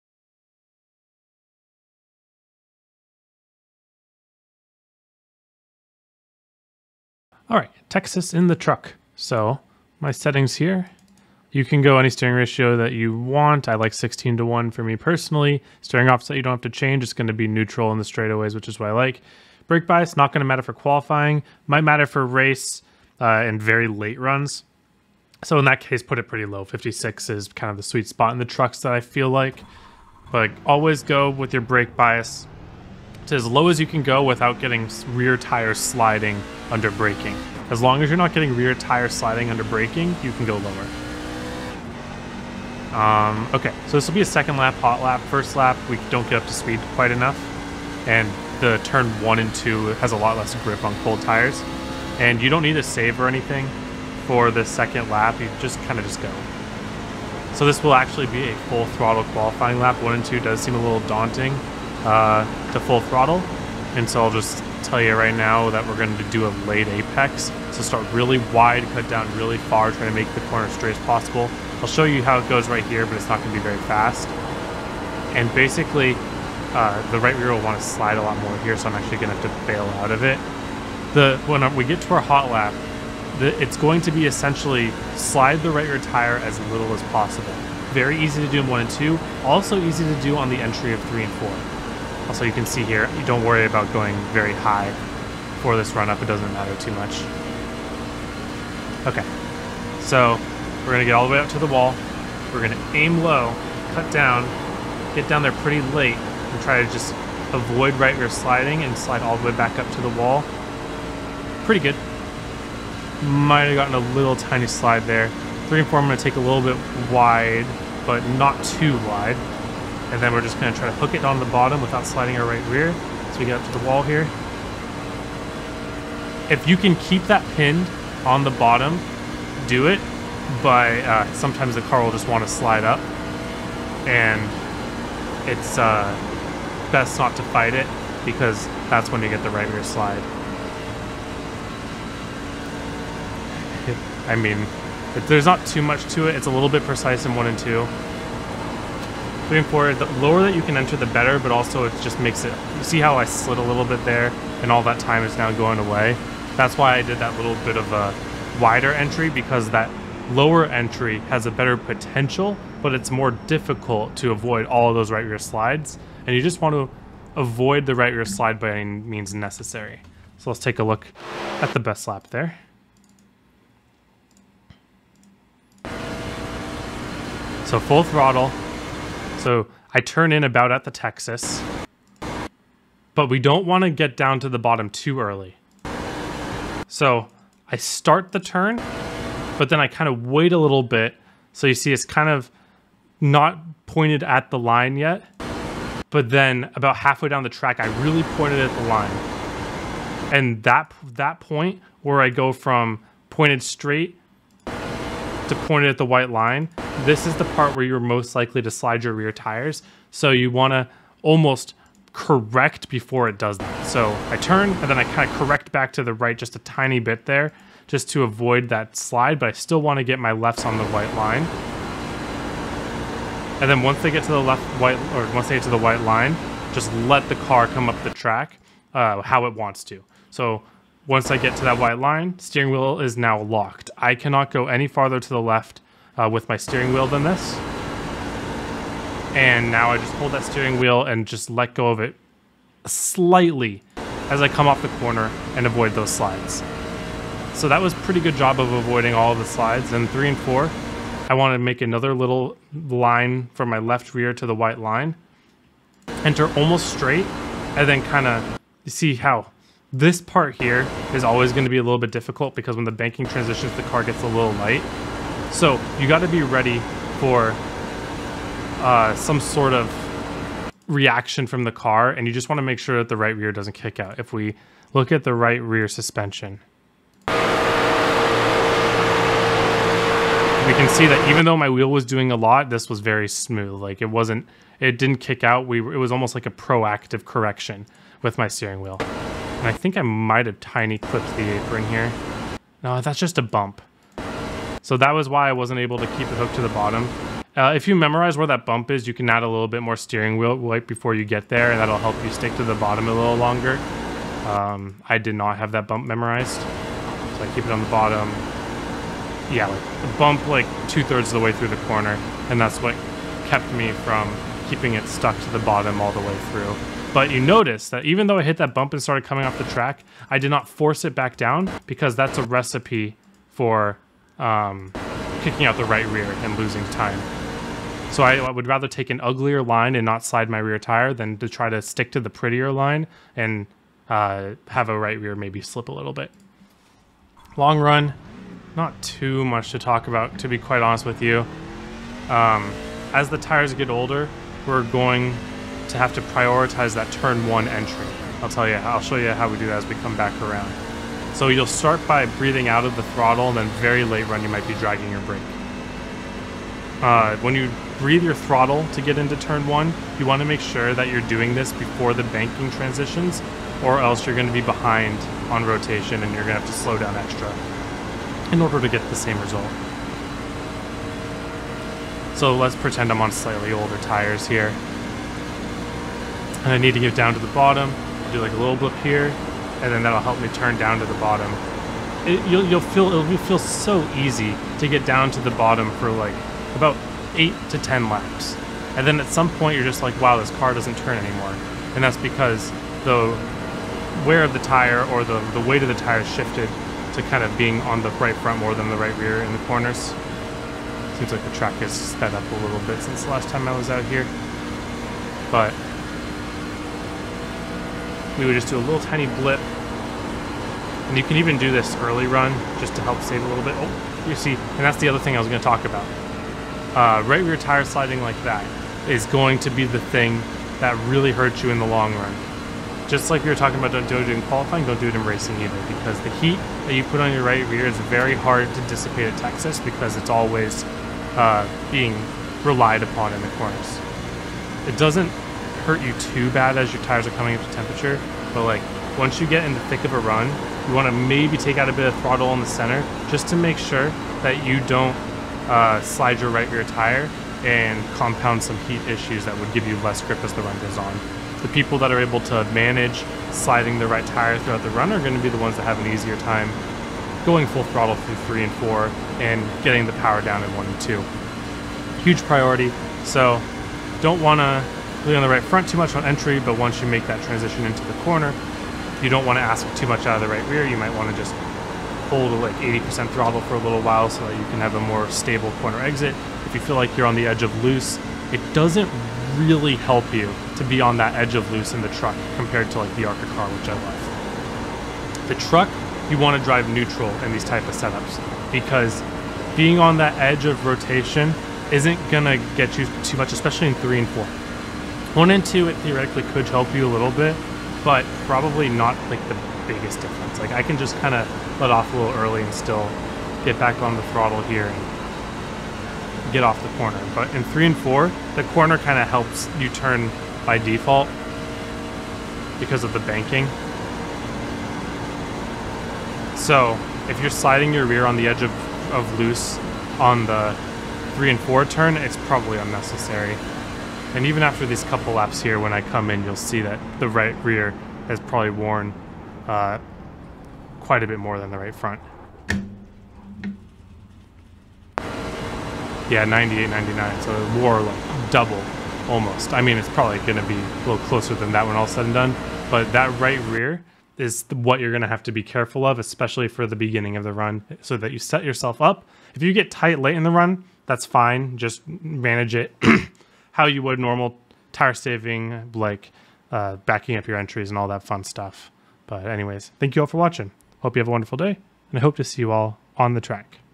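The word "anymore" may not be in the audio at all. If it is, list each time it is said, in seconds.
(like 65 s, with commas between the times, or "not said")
391 s.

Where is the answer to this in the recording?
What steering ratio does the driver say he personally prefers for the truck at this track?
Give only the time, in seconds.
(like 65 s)
13 s.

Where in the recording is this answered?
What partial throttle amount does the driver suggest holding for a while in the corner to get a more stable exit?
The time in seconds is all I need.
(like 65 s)
472 s.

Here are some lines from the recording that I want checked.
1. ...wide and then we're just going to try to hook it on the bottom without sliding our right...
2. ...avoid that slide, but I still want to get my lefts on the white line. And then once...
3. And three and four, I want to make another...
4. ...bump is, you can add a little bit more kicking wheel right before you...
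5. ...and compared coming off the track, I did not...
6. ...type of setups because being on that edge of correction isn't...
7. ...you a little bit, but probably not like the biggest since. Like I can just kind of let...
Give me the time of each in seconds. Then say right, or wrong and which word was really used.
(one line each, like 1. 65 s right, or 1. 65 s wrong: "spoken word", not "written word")
1. 118 s right
2. 218 s right
3. 249 s right
4. 298 s wrong: "steering", not "kicking"
5. 318 s wrong: "started", not "compared"
6. 487 s wrong: "rotation", not "correction"
7. 496 s wrong: "difference", not "since".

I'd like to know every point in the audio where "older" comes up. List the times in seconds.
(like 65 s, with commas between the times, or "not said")
343 s, 373 s.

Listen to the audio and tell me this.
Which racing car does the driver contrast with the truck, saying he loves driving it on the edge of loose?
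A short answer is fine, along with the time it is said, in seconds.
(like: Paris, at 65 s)
the ARCA car, at 483 s.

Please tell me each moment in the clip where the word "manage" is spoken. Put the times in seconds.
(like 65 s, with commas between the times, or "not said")
452 s, 552 s.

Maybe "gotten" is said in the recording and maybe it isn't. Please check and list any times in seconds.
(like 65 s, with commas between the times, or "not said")
113 s.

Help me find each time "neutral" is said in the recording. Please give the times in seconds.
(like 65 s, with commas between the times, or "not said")
17 s, 486 s.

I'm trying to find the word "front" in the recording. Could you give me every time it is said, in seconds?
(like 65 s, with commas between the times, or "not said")
398 s, 465 s, 531 s.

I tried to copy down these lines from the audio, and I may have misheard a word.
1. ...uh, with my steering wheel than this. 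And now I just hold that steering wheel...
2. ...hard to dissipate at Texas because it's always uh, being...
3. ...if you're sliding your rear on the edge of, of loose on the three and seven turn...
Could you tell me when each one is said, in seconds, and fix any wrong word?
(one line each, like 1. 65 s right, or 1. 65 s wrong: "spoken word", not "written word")
1. 236 s right
2. 428 s right
3. 517 s wrong: "four", not "seven".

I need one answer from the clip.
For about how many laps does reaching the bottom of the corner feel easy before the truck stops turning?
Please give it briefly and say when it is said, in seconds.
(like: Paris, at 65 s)
8 to 10, at 387 s.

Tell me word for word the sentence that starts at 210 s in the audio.
So you want to almost correct before it does that.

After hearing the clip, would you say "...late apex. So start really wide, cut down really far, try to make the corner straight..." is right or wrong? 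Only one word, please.
right.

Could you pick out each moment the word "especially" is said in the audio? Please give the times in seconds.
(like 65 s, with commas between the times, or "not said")
493 s, 546 s.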